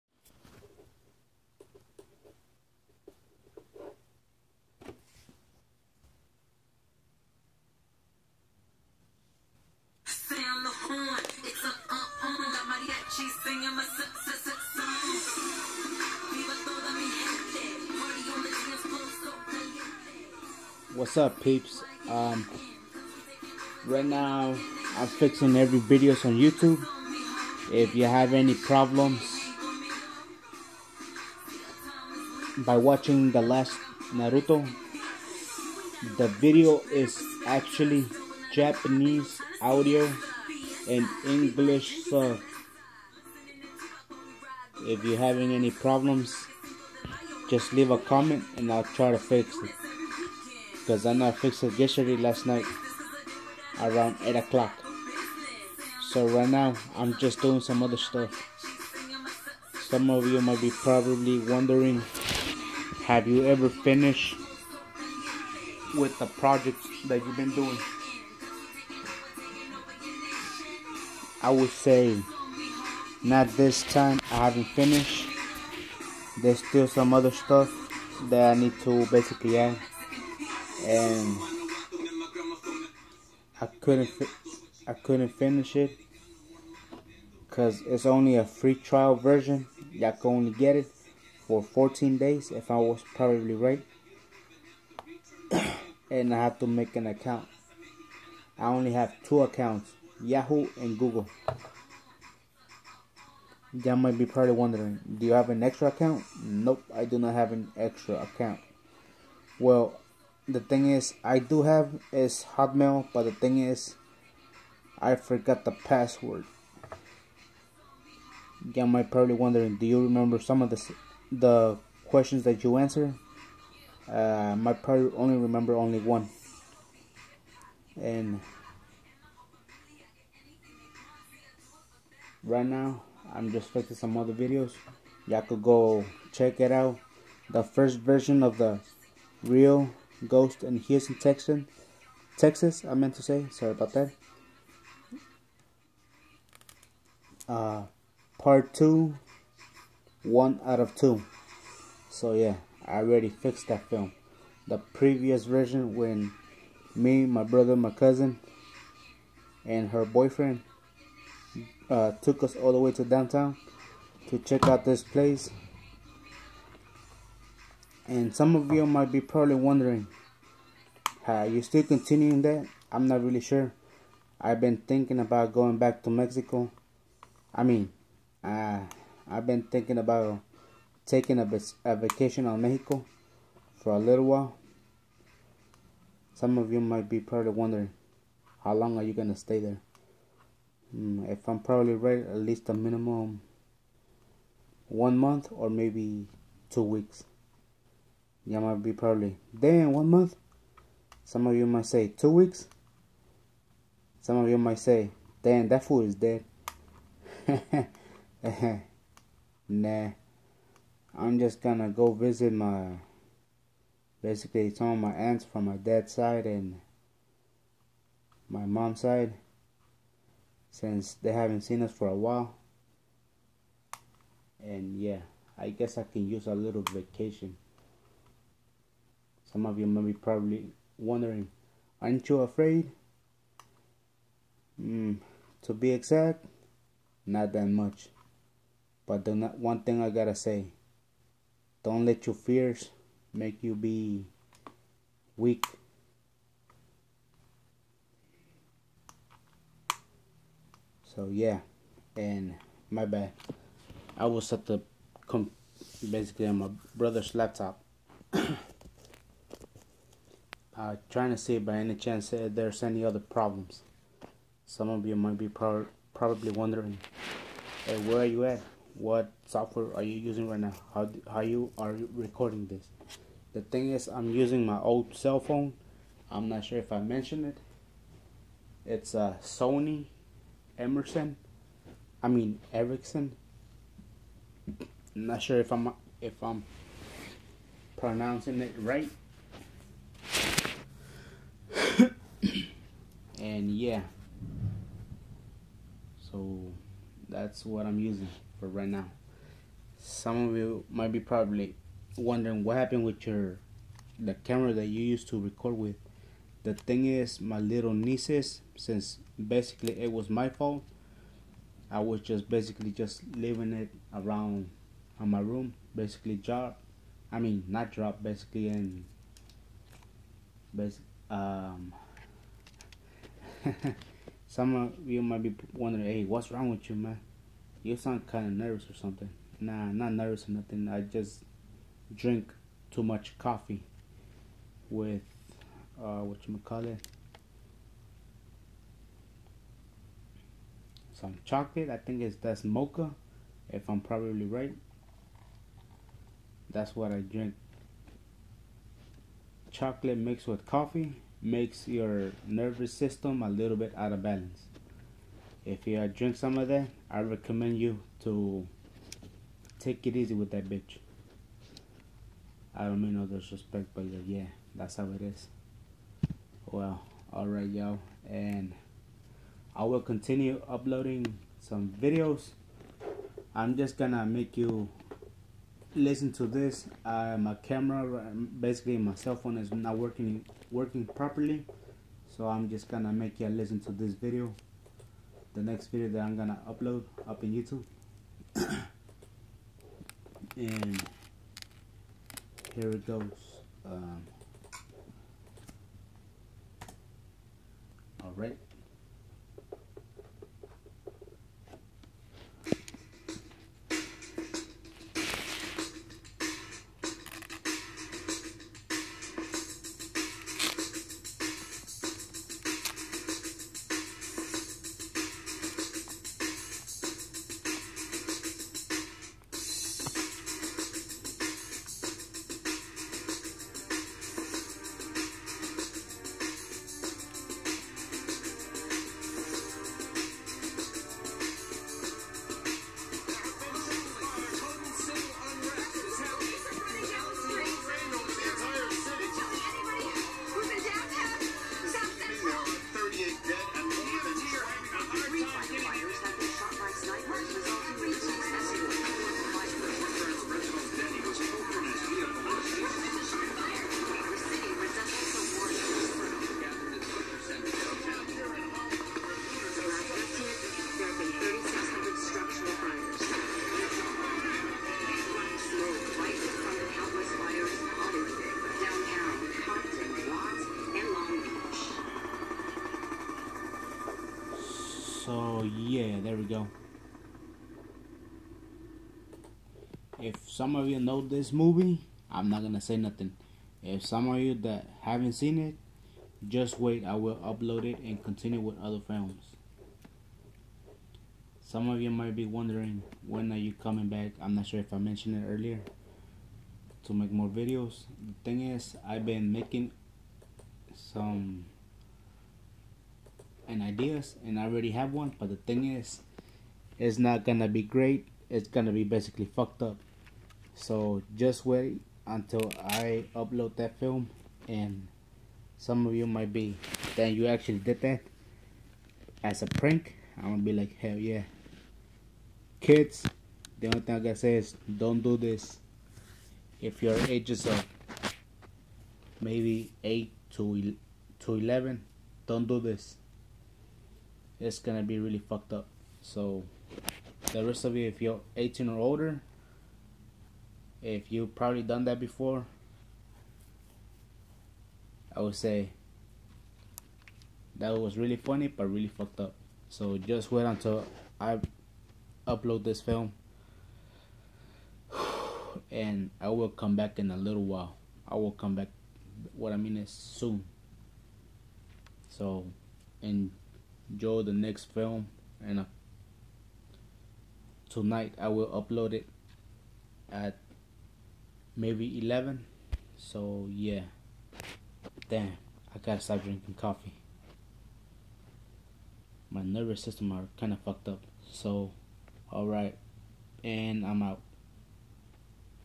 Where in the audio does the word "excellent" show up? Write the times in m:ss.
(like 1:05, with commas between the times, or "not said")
not said.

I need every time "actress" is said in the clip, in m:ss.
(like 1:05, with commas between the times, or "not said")
not said.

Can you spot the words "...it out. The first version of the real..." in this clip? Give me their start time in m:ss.
2:16.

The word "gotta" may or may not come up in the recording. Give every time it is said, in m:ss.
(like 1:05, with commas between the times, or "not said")
4:00, 8:44, 9:35.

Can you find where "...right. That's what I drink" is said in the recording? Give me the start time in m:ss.
5:44.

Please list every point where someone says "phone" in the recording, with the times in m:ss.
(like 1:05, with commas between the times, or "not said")
4:35, 6:19.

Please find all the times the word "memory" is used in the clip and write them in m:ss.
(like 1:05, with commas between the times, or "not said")
not said.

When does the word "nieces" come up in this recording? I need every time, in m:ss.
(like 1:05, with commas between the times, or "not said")
5:07.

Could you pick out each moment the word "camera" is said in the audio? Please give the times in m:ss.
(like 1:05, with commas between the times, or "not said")
5:04, 6:17.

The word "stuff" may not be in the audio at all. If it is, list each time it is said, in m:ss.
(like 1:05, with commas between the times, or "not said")
0:57, 1:17.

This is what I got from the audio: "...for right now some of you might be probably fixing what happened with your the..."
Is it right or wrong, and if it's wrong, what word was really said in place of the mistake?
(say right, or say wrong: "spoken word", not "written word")
wrong: "wondering", not "fixing".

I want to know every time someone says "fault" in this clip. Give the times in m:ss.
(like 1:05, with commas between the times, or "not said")
5:10.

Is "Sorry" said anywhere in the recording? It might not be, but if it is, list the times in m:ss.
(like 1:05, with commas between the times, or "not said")
2:23.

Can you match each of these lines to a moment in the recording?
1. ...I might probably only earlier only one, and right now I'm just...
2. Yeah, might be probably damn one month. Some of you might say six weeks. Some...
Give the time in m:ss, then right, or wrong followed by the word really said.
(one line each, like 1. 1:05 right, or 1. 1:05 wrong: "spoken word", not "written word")
1. 2:04 wrong: "remember", not "earlier"
2. 3:18 wrong: "two", not "six".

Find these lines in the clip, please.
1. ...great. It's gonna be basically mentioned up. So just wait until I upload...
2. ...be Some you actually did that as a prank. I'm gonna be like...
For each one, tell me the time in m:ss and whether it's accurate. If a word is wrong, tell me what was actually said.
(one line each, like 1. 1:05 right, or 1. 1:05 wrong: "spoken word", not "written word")
1. 8:27 wrong: "fucked", not "mentioned"
2. 8:36 wrong: "Then", not "Some".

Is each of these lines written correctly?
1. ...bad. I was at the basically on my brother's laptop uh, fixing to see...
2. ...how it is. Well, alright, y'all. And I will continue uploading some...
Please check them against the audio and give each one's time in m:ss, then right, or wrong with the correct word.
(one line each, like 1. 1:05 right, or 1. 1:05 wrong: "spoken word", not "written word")
1. 4:13 wrong: "trying", not "fixing"
2. 6:04 right.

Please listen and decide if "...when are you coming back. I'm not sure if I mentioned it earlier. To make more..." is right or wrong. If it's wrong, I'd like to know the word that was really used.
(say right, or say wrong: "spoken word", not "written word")
right.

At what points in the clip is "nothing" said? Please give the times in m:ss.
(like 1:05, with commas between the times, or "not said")
5:30, 8:02.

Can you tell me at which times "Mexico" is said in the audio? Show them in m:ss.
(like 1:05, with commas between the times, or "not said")
2:56, 3:02.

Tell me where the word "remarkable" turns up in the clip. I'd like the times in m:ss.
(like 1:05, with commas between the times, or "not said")
not said.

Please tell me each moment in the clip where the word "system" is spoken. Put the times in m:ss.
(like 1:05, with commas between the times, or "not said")
5:52, 9:40.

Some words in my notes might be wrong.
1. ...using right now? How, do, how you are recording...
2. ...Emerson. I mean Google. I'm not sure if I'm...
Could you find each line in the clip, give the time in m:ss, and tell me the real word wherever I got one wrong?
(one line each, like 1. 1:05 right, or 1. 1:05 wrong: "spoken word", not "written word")
1. 4:30 right
2. 4:40 wrong: "Ericsson", not "Google".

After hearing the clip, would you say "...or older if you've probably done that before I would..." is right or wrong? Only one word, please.
right.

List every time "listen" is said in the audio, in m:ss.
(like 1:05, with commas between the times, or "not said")
6:15, 6:23.